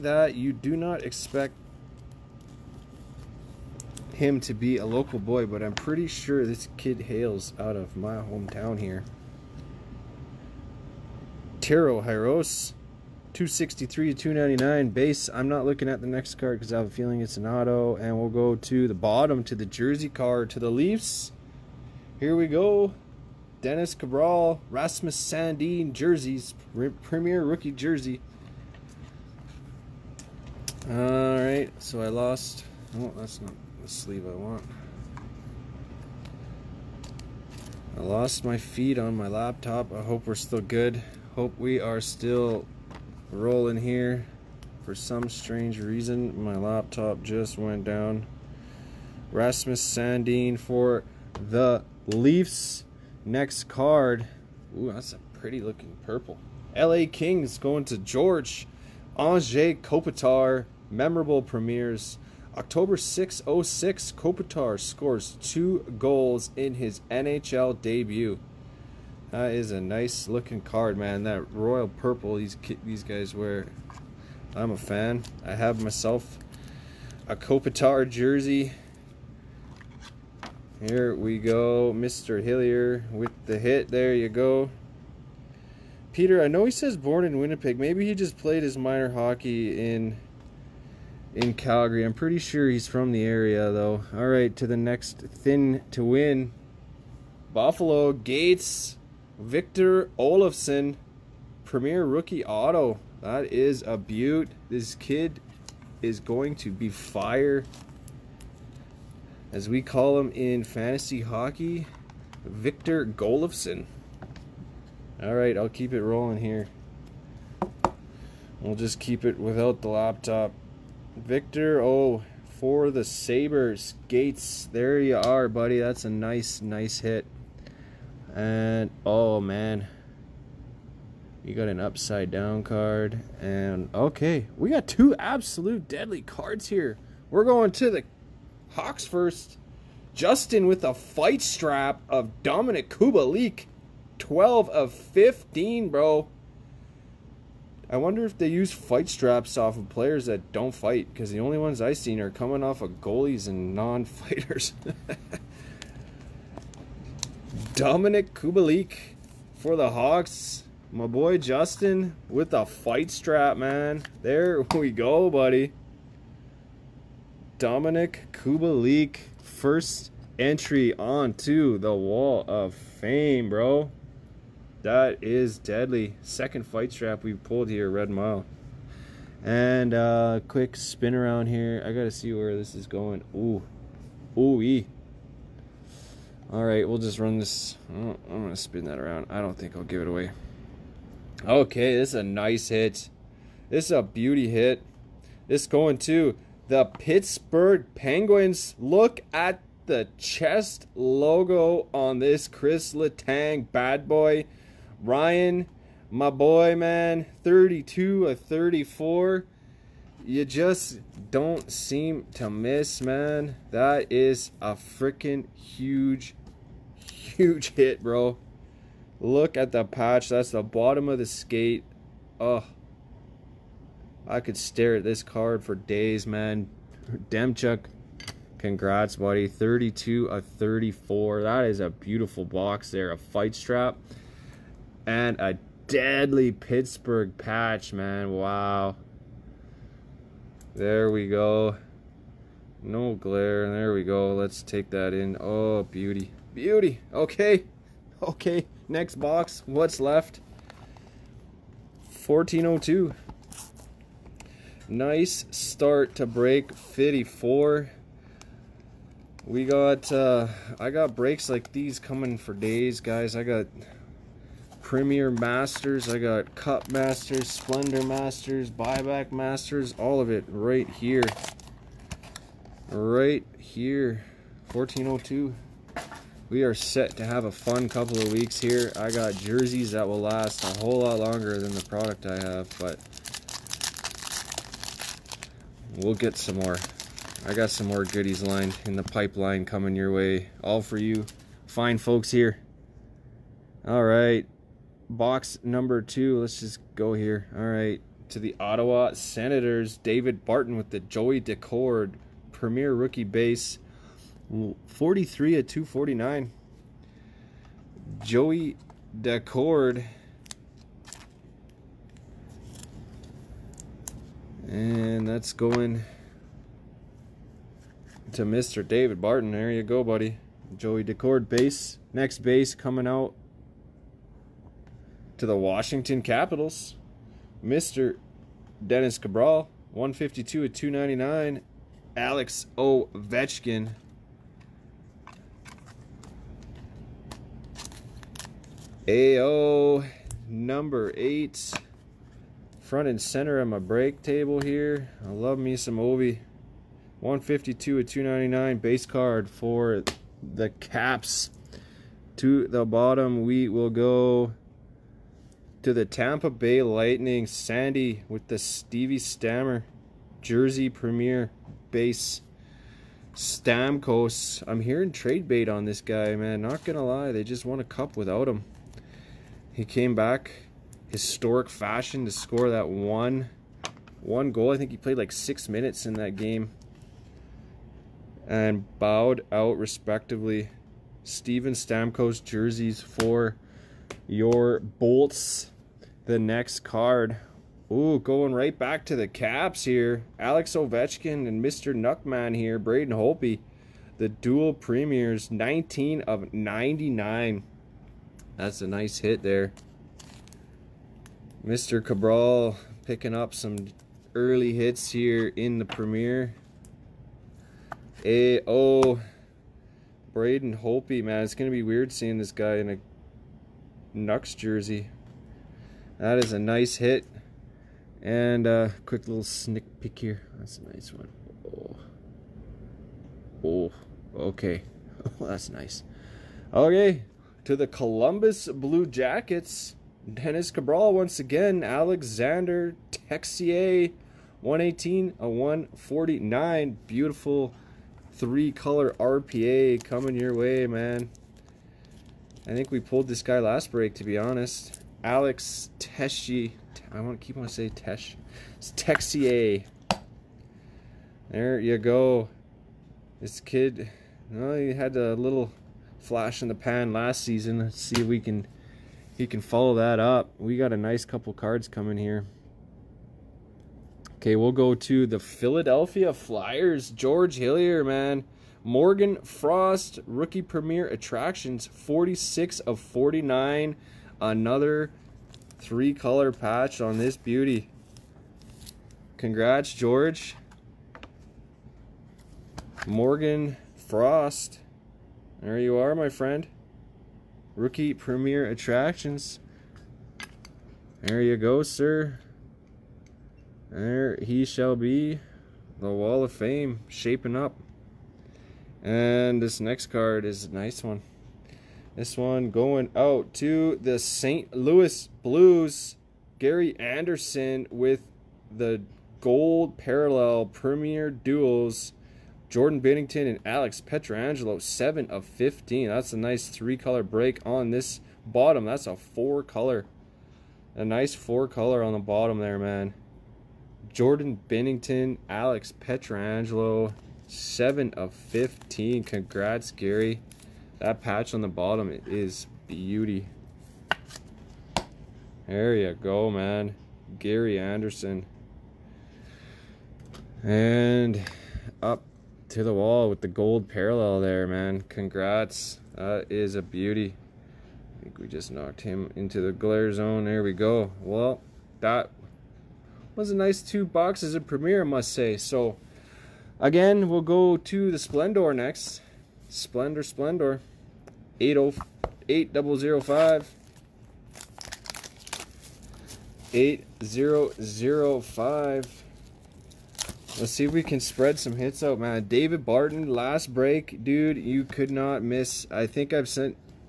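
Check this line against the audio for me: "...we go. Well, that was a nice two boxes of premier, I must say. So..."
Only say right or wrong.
right.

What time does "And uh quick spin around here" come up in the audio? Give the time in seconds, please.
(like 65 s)
179 s.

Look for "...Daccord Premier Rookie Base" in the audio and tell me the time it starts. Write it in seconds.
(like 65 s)
301 s.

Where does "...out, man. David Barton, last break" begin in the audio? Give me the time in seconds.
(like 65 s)
572 s.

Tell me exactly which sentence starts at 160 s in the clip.
My boy Justin with the fight strap, man.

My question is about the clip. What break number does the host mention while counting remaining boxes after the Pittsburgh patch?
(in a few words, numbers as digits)
54.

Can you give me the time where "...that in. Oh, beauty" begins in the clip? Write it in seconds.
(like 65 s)
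244 s.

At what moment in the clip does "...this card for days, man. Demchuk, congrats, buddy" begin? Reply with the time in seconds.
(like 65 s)
225 s.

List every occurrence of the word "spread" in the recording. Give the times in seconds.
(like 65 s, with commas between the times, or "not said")
571 s.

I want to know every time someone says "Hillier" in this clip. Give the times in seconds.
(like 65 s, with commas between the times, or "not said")
82 s, 467 s.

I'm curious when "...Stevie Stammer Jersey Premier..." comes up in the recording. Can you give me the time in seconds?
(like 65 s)
358 s.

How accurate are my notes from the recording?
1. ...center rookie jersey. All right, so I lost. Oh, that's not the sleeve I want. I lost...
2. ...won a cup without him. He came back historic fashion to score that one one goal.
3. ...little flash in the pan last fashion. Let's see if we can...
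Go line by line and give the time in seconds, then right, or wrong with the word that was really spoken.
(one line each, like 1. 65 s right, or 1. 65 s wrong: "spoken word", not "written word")
1. 27 s wrong: "premier", not "center"
2. 367 s right
3. 455 s wrong: "season", not "fashion".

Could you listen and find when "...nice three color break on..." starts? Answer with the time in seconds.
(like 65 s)
516 s.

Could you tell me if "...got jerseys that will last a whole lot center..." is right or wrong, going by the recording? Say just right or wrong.
wrong.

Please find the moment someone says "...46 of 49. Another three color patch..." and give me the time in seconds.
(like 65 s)
471 s.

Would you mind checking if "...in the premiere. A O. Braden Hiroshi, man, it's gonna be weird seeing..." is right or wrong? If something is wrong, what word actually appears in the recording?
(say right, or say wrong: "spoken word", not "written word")
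wrong: "Holtby", not "Hiroshi".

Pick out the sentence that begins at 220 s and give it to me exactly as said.
That's the bottom of the skate.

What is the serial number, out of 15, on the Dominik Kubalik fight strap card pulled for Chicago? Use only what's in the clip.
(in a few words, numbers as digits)
12.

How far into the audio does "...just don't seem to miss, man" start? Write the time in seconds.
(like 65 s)
210 s.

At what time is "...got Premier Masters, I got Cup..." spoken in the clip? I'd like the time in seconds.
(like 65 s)
263 s.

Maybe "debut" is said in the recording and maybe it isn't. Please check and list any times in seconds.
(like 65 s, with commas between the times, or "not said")
67 s.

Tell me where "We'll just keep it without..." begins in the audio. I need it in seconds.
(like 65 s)
118 s.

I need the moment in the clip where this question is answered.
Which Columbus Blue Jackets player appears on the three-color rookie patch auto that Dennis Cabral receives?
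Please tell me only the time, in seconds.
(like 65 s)
431 s.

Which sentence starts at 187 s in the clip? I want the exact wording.
Oh, I'm gonna spin that around.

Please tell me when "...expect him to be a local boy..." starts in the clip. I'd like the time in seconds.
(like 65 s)
1 s.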